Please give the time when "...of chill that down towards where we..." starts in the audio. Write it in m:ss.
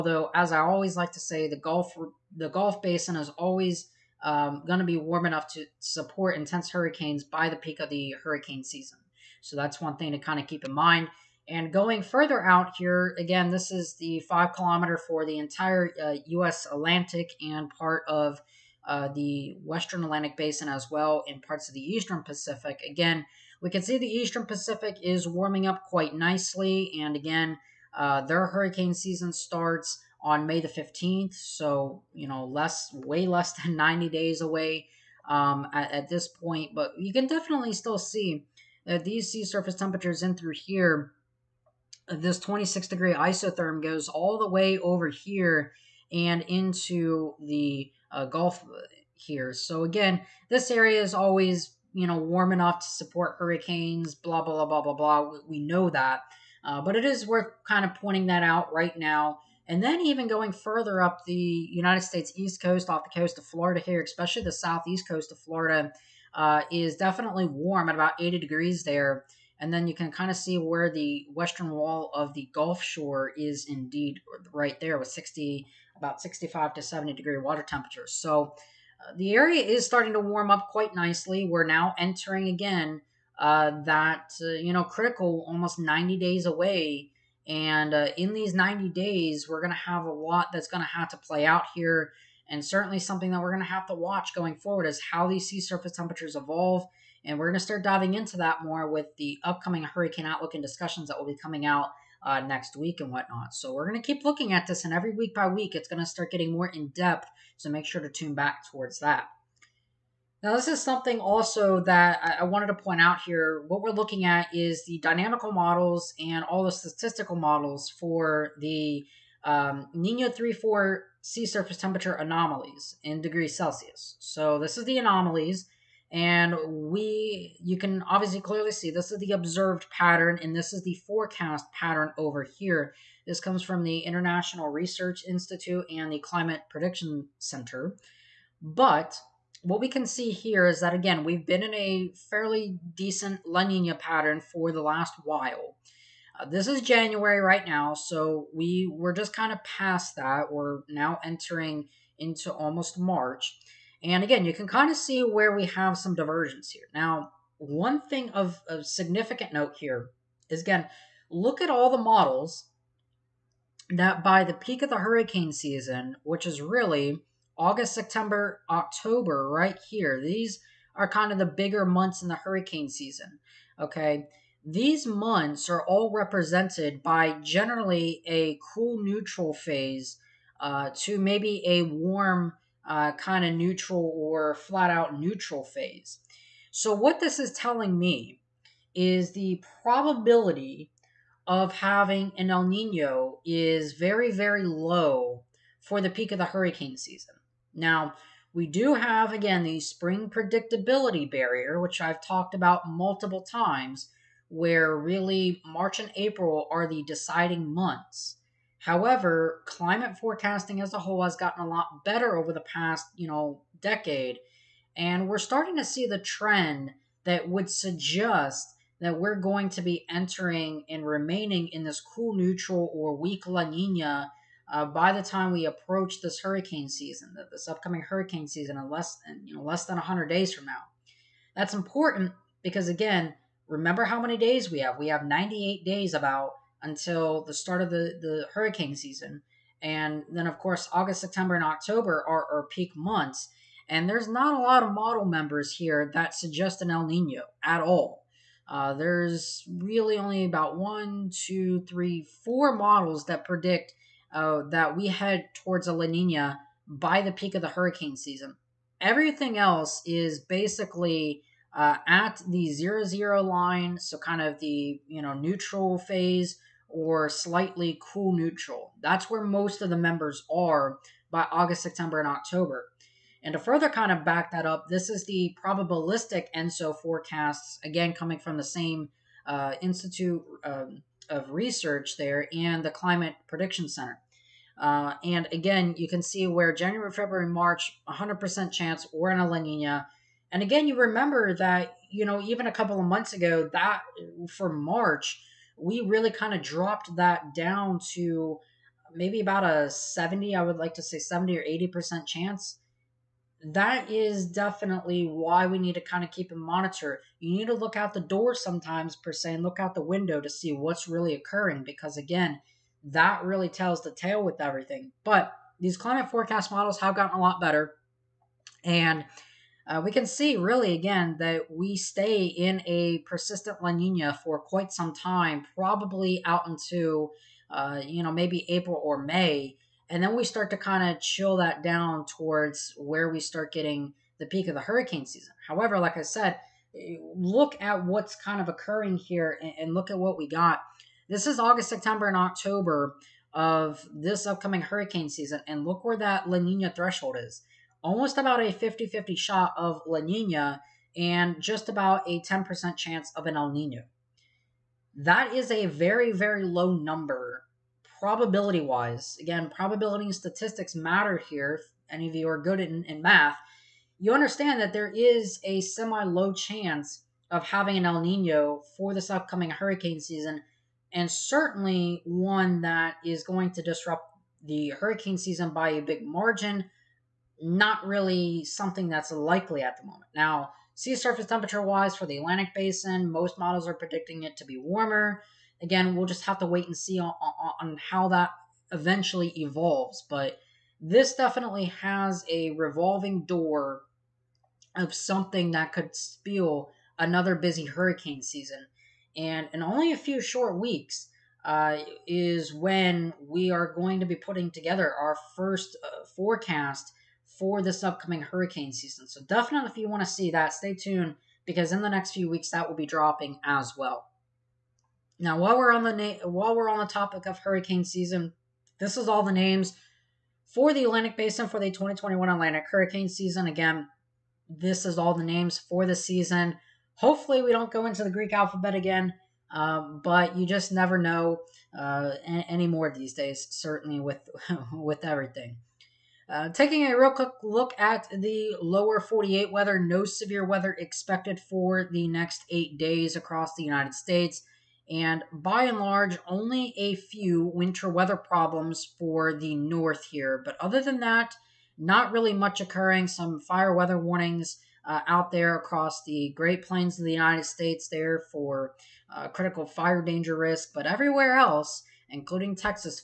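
5:31.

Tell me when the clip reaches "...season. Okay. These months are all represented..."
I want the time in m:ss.
2:52.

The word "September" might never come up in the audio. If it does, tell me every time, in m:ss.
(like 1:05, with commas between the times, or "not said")
2:47, 4:01, 4:31, 5:41.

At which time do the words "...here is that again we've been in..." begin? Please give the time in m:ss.
2:20.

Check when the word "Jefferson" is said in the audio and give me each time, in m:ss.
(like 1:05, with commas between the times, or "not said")
not said.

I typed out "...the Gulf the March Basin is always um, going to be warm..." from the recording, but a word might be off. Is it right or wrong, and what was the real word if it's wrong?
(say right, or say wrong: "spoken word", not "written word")
wrong: "Gulf", not "March".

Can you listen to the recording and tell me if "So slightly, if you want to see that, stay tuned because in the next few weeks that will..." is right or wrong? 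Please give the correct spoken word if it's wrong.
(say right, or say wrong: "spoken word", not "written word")
wrong: "definitely", not "slightly".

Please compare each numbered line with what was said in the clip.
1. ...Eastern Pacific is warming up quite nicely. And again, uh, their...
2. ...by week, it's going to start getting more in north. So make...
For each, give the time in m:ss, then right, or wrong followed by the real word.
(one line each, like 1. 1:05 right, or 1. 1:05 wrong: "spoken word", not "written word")
1. 0:24 right
2. 1:45 wrong: "depth", not "north".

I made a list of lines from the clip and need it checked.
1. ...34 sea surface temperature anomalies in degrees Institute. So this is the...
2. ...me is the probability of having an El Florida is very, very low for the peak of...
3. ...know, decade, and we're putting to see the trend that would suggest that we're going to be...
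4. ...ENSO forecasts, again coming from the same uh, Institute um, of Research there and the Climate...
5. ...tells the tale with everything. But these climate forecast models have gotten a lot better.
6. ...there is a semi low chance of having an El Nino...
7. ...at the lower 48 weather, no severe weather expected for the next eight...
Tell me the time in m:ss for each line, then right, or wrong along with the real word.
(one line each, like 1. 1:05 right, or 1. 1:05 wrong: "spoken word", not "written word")
1. 2:00 wrong: "Celsius", not "Institute"
2. 3:07 wrong: "Nino", not "Florida"
3. 3:33 wrong: "starting", not "putting"
4. 4:36 right
5. 5:13 right
6. 6:04 right
7. 7:17 right.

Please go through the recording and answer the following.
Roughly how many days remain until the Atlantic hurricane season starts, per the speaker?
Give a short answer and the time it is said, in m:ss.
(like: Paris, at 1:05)
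98, at 3:55.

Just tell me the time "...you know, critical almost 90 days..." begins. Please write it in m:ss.
1:24.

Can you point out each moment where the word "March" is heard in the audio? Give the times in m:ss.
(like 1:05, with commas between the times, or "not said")
2:32, 3:25, 4:47, 4:54.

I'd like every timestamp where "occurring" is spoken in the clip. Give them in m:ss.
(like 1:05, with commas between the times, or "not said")
5:11, 5:38, 7:32.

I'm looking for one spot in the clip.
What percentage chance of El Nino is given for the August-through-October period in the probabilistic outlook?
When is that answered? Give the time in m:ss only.
5:52.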